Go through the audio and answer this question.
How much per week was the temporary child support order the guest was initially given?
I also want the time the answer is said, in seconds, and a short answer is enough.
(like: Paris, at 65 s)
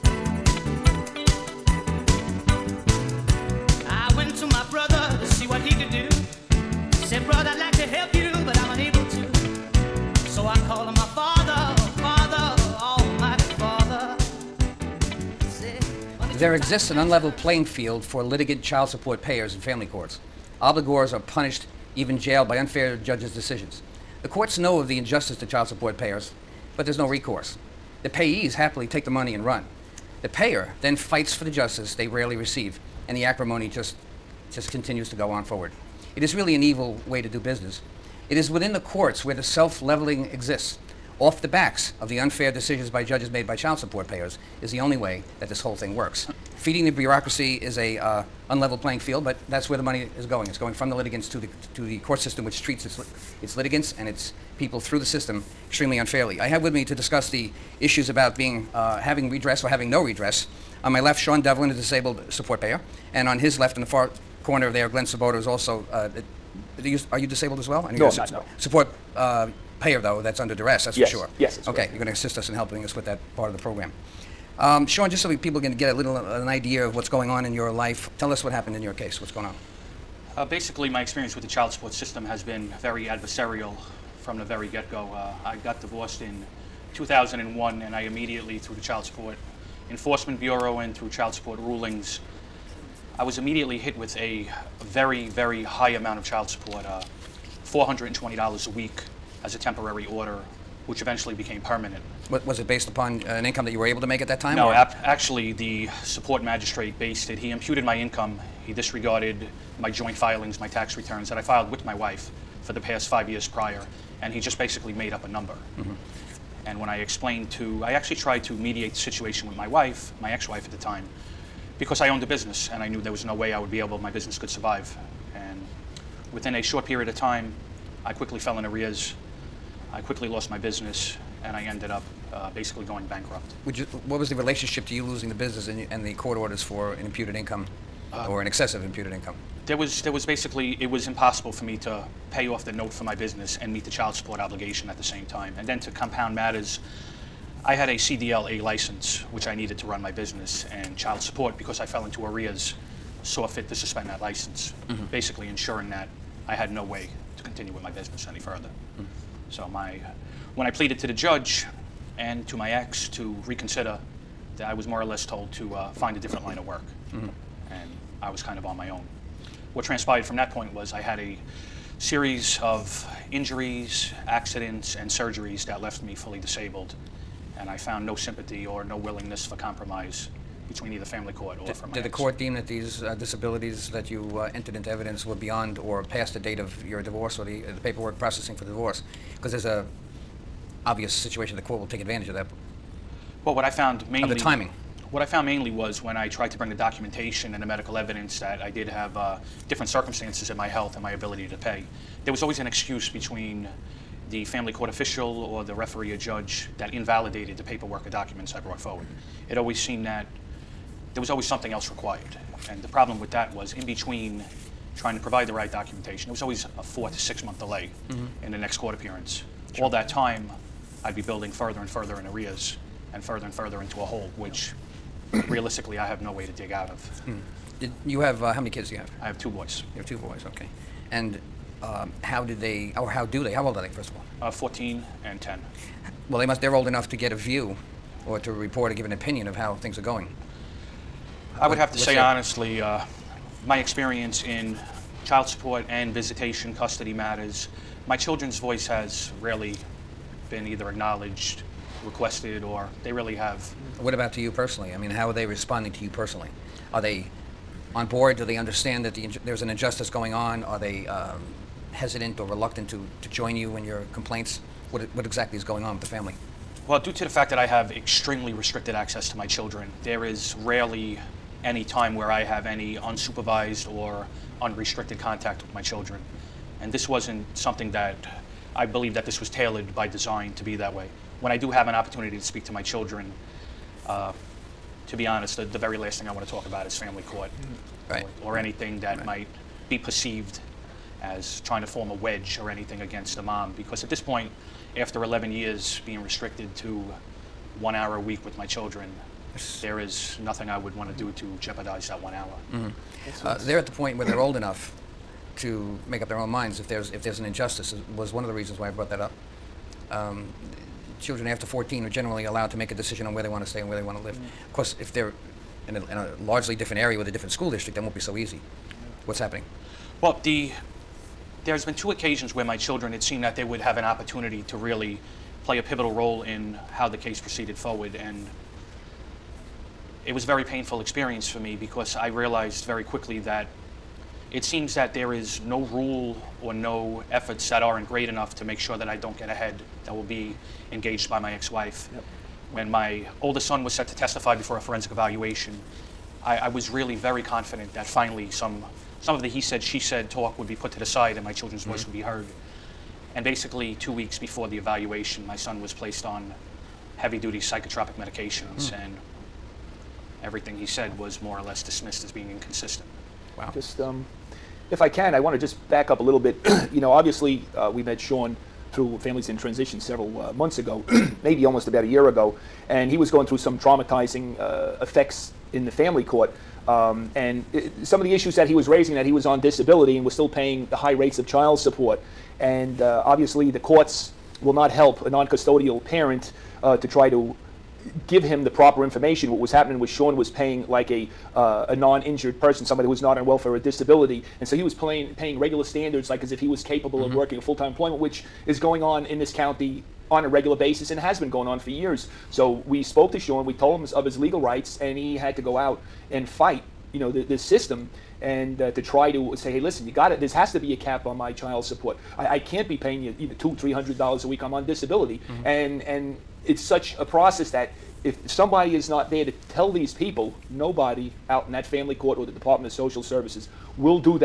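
$420, at 97 s.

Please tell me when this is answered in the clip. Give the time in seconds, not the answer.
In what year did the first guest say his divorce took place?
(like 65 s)
86 s.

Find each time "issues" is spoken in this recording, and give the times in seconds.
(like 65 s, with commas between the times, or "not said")
57 s, 378 s.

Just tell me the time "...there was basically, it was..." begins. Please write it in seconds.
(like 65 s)
140 s.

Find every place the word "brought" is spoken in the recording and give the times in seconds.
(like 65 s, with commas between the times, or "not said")
208 s, 308 s.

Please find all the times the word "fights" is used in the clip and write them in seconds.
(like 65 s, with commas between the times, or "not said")
30 s, 406 s.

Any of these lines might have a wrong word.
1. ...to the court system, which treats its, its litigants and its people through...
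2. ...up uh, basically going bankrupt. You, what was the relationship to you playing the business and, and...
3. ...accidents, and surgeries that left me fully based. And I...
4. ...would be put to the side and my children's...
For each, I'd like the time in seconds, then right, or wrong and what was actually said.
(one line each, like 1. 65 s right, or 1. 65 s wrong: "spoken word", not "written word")
1. 51 s right
2. 131 s wrong: "losing", not "playing"
3. 174 s wrong: "disabled", not "based"
4. 350 s right.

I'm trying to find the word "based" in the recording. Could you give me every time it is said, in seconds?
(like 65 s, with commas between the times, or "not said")
102 s, 106 s.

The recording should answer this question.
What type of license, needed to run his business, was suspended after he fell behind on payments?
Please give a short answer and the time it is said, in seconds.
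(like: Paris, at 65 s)
CDL A, at 147 s.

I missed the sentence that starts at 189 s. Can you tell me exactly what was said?
Because there's a obvious situation the court will take advantage of that well, what I found mainly...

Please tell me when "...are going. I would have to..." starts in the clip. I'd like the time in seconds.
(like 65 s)
239 s.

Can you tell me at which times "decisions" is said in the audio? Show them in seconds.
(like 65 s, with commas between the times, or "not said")
23 s, 42 s, 312 s.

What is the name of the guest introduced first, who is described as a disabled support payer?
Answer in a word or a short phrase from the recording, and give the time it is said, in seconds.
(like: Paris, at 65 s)
Sean Delevan, at 61 s.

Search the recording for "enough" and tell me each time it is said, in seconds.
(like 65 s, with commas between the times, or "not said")
236 s, 304 s, 338 s.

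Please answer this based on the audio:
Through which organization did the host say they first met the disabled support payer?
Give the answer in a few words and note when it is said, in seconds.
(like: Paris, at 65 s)
Families in Transition, at 369 s.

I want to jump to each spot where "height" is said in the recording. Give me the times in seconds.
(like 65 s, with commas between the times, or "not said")
not said.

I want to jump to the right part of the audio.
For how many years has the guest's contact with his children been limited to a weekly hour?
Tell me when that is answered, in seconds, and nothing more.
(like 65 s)
295 s.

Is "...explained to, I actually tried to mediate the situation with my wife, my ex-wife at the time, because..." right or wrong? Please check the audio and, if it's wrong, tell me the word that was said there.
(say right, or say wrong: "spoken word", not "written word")
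right.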